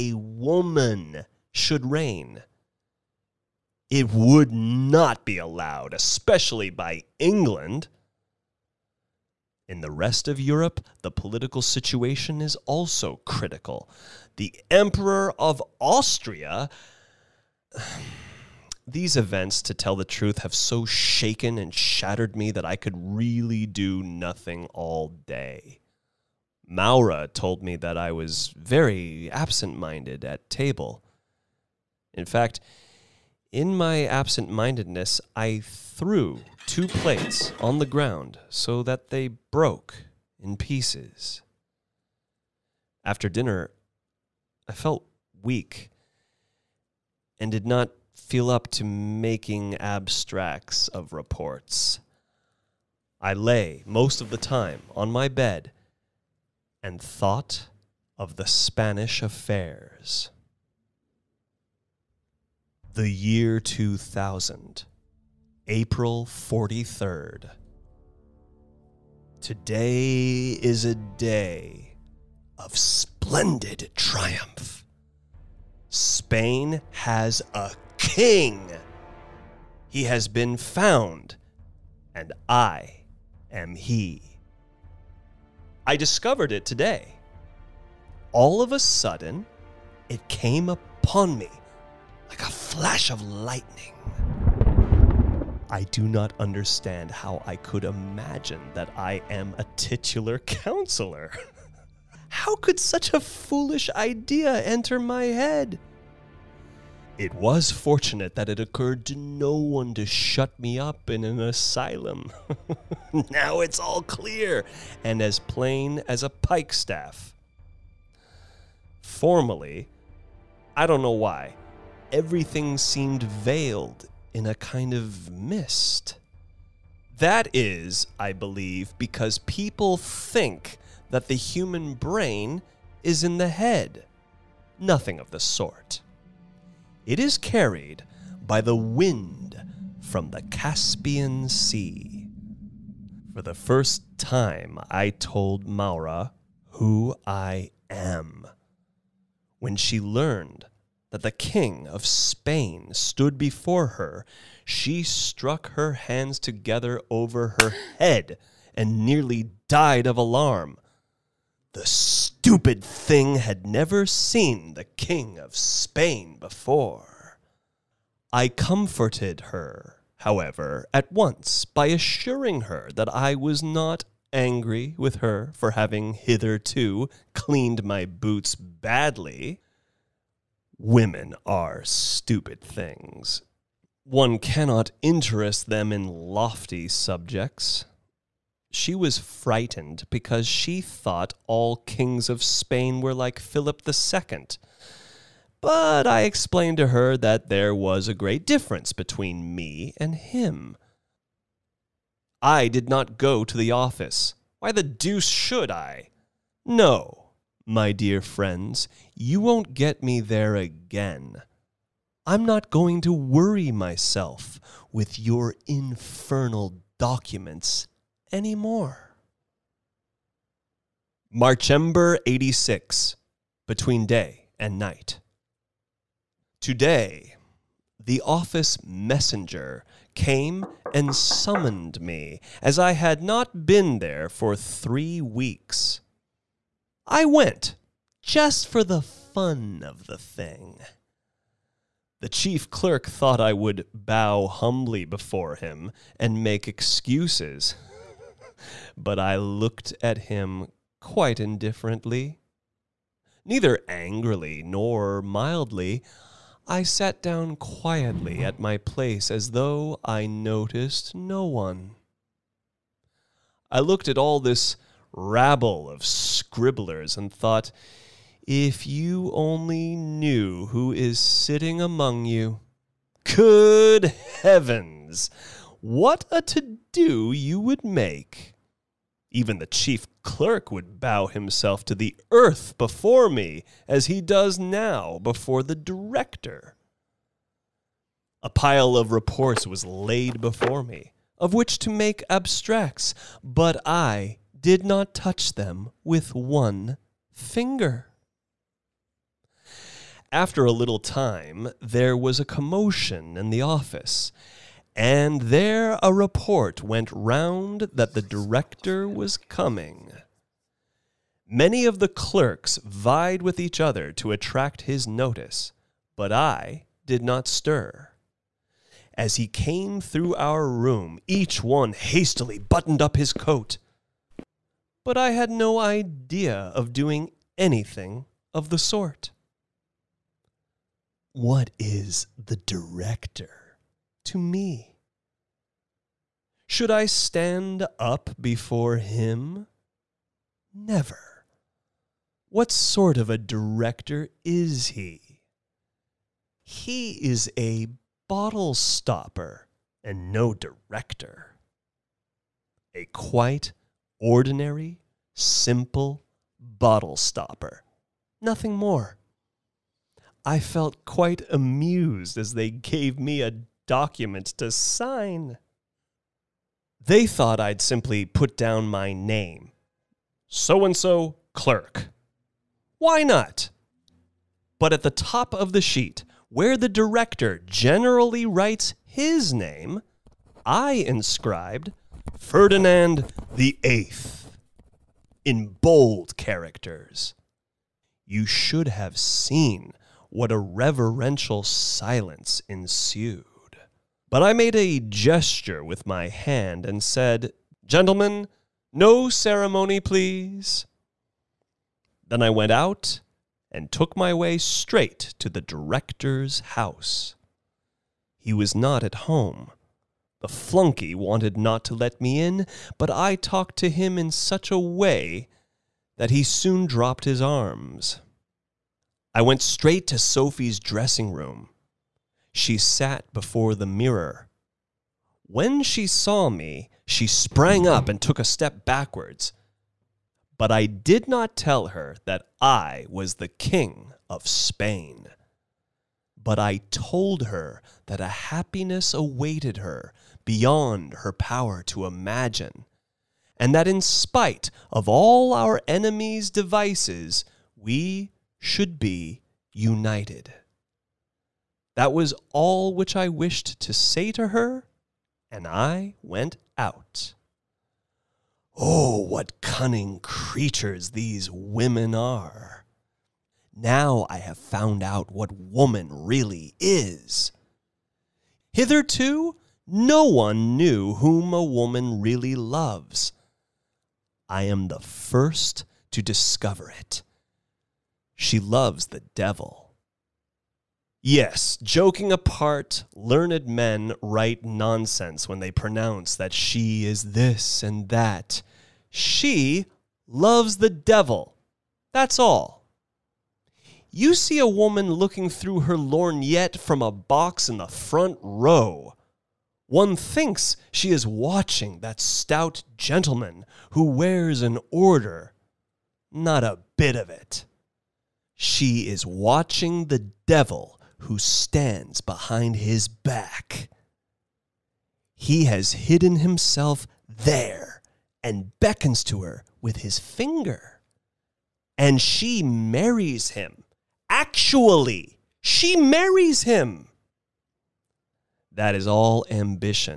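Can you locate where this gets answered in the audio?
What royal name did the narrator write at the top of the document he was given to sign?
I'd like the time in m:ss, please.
6:22.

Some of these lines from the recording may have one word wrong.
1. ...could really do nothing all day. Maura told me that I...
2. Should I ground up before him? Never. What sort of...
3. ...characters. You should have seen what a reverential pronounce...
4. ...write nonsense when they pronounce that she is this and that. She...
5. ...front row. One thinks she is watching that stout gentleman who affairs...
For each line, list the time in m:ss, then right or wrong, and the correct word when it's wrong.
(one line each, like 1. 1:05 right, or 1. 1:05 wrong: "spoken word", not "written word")
1. 0:22 right
2. 5:36 wrong: "stand", not "ground"
3. 6:26 wrong: "silence", not "pronounce"
4. 8:04 right
5. 8:17 wrong: "wears", not "affairs".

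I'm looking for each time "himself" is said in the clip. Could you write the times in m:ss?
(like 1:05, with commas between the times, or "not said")
4:41, 8:36.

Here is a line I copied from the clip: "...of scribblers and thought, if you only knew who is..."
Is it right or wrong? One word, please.
right.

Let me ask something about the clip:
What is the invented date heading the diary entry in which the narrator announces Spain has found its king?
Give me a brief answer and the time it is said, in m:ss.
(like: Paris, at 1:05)
The year 2000, April 43rd, at 1:02.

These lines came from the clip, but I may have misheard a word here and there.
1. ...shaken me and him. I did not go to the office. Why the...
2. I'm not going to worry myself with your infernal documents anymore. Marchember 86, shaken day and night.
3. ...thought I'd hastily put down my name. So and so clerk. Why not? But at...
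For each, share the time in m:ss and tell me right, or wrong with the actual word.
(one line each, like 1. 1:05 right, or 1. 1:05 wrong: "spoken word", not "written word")
1. 3:18 wrong: "between", not "shaken"
2. 3:32 wrong: "between", not "shaken"
3. 6:07 wrong: "simply", not "hastily".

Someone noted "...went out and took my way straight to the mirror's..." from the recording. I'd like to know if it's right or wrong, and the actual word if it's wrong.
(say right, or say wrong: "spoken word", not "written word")
wrong: "director", not "mirror".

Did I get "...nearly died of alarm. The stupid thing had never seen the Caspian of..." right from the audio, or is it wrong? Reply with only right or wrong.
wrong.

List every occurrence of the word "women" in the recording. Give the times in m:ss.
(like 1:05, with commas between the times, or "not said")
3:00, 7:41.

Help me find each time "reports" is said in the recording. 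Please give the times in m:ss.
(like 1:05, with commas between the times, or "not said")
0:51, 4:49, 5:06.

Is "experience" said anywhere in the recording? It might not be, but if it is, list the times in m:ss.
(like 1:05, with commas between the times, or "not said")
not said.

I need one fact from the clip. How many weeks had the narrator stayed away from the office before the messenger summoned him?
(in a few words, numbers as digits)
3.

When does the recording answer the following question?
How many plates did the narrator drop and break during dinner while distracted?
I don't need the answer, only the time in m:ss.
0:36.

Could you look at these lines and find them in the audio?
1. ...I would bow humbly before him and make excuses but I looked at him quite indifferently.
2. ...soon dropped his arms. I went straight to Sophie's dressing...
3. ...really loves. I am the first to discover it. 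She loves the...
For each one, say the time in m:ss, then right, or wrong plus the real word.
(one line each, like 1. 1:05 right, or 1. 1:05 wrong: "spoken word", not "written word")
1. 4:03 right
2. 6:56 right
3. 7:52 right.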